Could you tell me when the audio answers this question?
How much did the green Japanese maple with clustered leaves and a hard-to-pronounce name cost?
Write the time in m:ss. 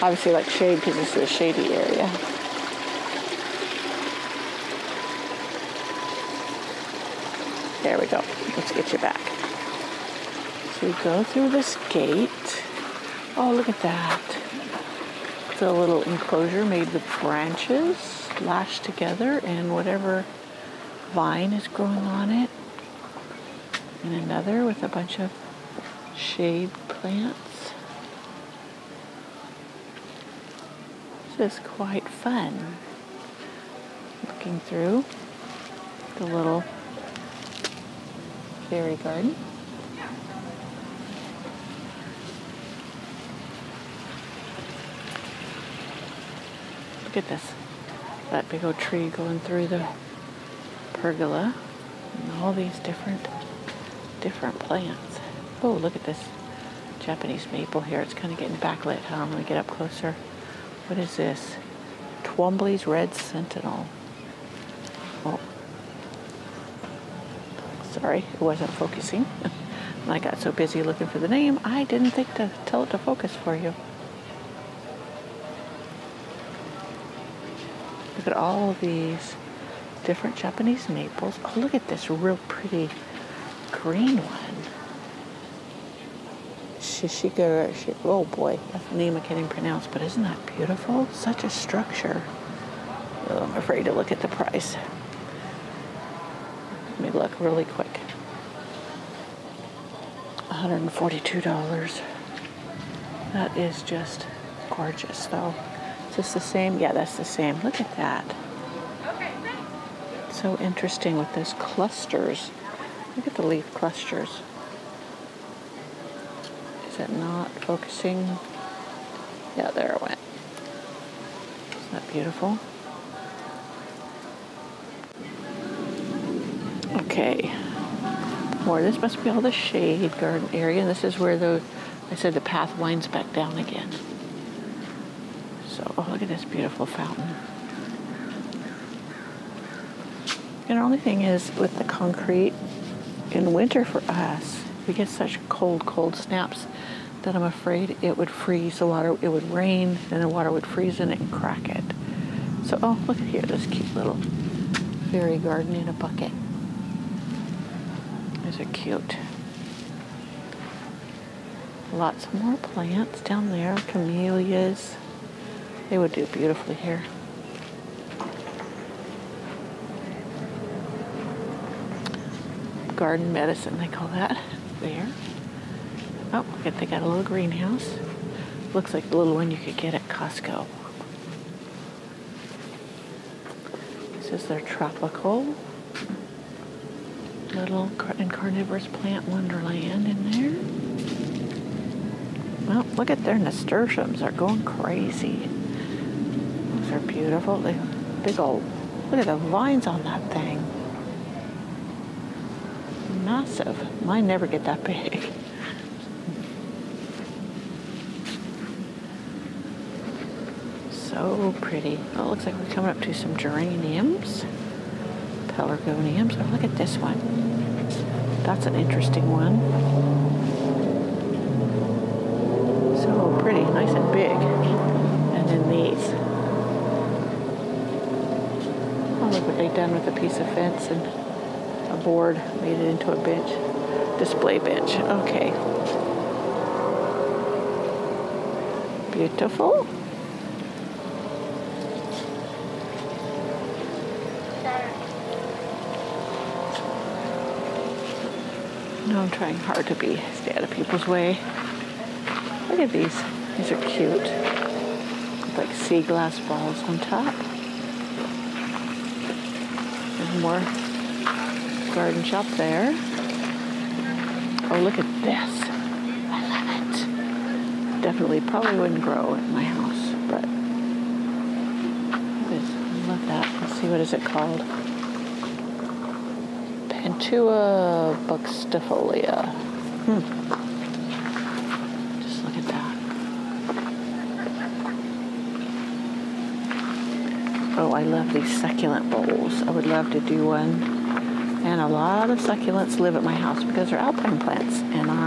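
1:40.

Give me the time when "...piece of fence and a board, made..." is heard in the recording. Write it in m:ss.
3:50.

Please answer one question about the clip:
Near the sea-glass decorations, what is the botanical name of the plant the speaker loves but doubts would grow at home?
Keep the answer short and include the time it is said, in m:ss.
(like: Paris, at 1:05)
Cantua buxifolia, at 4:36.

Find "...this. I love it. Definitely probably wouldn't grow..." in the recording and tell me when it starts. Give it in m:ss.
4:25.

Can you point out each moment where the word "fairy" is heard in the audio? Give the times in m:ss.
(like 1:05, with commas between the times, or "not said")
0:38, 2:35.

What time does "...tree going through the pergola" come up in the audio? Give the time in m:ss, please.
0:48.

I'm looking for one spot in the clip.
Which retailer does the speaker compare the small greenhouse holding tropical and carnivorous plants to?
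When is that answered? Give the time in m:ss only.
3:00.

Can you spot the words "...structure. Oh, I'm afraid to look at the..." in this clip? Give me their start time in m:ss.
1:31.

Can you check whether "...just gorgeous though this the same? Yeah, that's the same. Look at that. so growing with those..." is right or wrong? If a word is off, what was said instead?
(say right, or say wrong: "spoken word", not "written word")
wrong: "interesting", not "growing".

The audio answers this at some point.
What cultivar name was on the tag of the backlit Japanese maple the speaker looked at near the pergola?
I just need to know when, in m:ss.
1:02.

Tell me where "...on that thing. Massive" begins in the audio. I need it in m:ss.
3:19.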